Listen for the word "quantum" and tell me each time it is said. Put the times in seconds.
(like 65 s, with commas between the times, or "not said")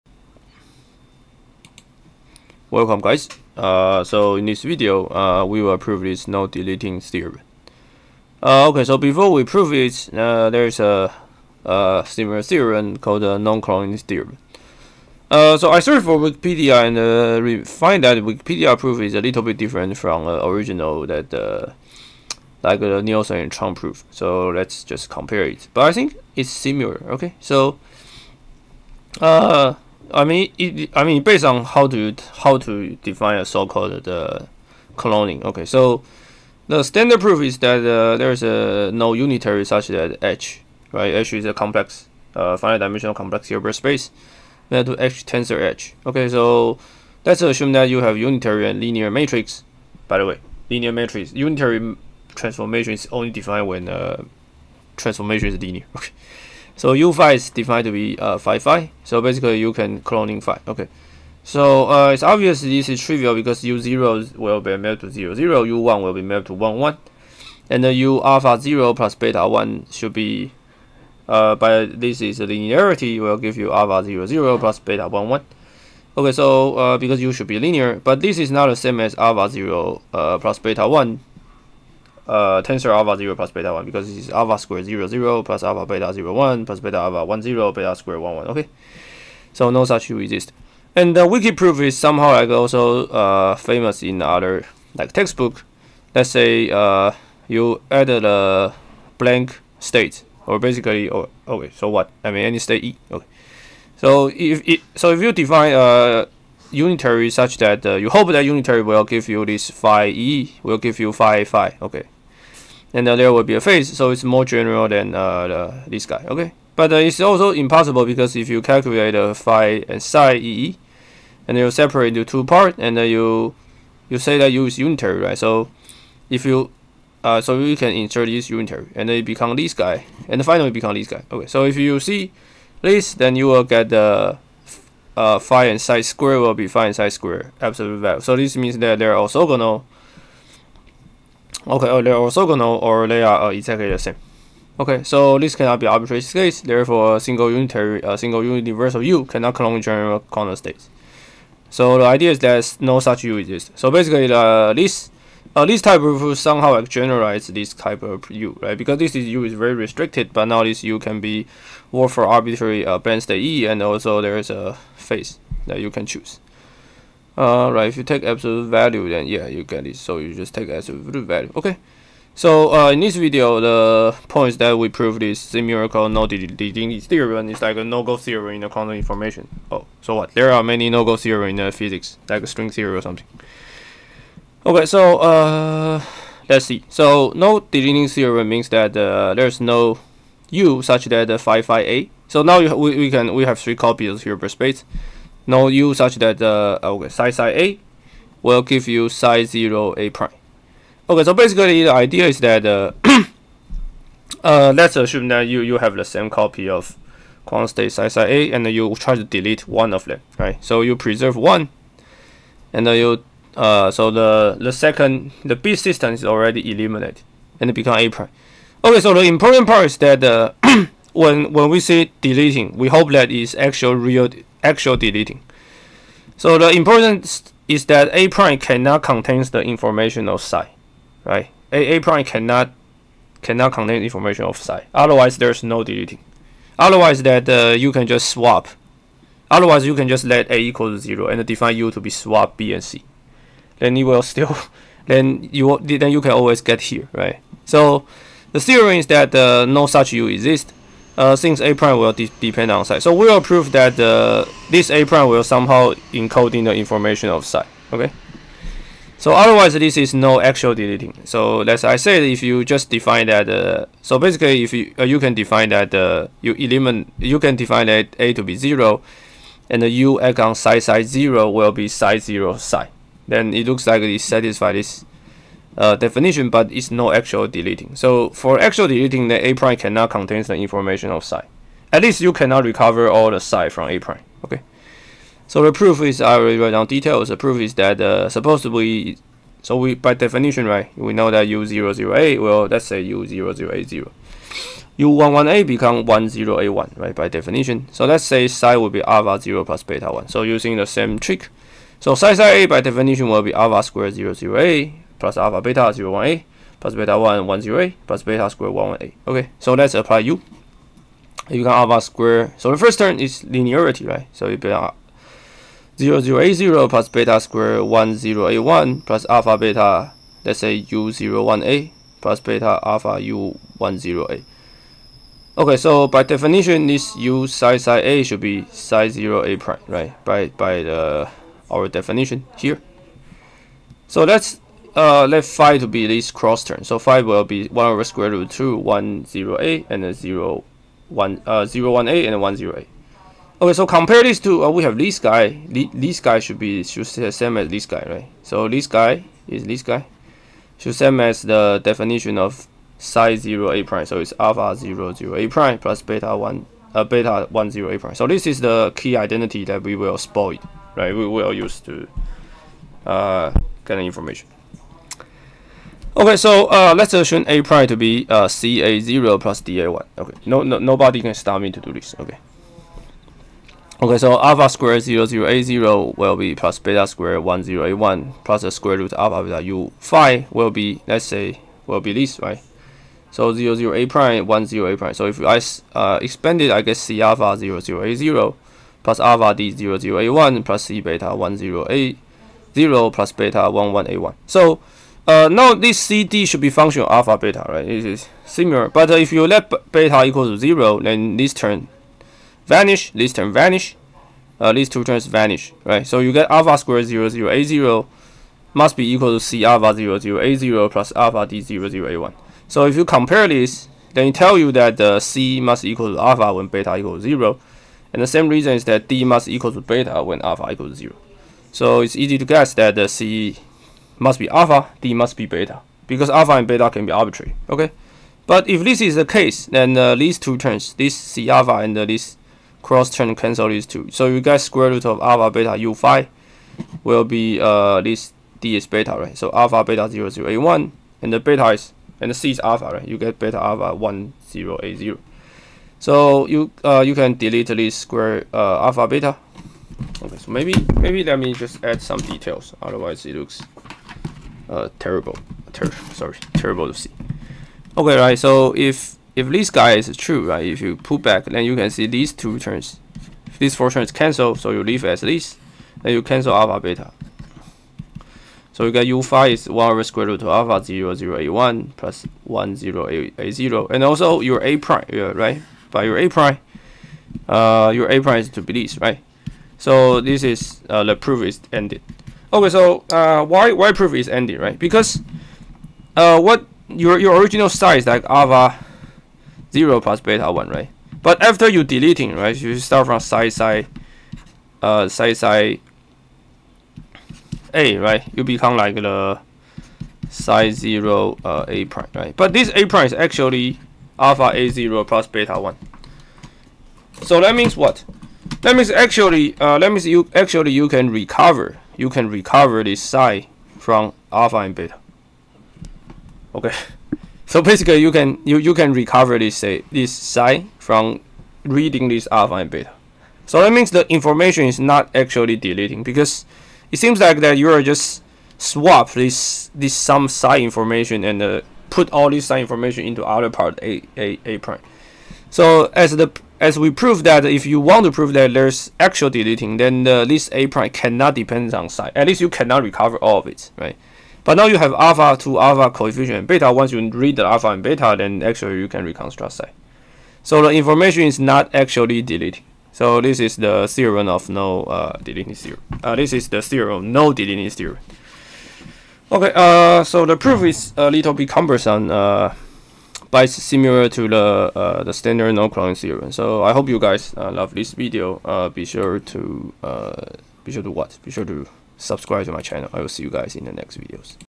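178 s, 207 s.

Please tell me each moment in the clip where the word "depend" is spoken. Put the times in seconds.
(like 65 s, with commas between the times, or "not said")
252 s, 541 s.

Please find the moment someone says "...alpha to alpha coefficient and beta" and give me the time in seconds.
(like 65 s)
544 s.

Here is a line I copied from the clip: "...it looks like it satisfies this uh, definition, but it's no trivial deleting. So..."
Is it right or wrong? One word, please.
wrong.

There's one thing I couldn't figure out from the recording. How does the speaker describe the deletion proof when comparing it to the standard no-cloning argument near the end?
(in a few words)
a little bit cumbersome.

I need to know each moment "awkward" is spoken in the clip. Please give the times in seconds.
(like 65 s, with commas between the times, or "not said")
not said.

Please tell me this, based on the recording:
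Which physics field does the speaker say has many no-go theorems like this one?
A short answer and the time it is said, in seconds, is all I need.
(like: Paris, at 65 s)
string theory, at 182 s.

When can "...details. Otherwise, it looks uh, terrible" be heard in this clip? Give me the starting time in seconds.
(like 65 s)
452 s.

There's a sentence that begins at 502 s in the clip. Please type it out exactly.
But this a prime is actually alpha A0 plus beta 1.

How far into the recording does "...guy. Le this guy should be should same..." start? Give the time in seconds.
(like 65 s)
345 s.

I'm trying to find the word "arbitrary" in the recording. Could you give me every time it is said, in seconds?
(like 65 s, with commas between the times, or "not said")
145 s, 162 s, 427 s.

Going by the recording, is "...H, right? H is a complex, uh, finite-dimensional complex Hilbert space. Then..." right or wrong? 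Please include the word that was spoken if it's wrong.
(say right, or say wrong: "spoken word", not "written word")
right.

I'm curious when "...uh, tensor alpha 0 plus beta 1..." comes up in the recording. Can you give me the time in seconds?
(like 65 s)
82 s.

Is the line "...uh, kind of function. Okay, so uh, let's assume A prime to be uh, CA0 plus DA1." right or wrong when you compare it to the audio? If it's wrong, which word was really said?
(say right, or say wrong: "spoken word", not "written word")
wrong: "information", not "function".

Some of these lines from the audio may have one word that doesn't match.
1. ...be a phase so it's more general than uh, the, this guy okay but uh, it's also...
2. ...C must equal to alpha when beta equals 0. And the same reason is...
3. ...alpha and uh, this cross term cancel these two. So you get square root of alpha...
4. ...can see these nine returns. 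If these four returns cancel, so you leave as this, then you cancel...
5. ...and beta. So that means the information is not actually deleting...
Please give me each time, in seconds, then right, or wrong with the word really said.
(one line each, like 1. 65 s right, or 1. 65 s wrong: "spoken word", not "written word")
1. 113 s right
2. 415 s right
3. 431 s right
4. 461 s wrong: "two", not "nine"
5. 522 s right.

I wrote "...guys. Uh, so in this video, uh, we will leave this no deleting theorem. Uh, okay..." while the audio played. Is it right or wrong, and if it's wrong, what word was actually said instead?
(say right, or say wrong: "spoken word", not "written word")
wrong: "prove", not "leave".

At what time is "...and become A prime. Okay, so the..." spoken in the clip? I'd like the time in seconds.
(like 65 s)
217 s.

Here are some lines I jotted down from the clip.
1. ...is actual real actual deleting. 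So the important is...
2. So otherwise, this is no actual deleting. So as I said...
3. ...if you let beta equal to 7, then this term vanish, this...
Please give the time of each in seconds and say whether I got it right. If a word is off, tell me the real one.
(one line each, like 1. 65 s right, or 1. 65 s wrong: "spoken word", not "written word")
1. 223 s right
2. 259 s right
3. 399 s wrong: "0", not "7".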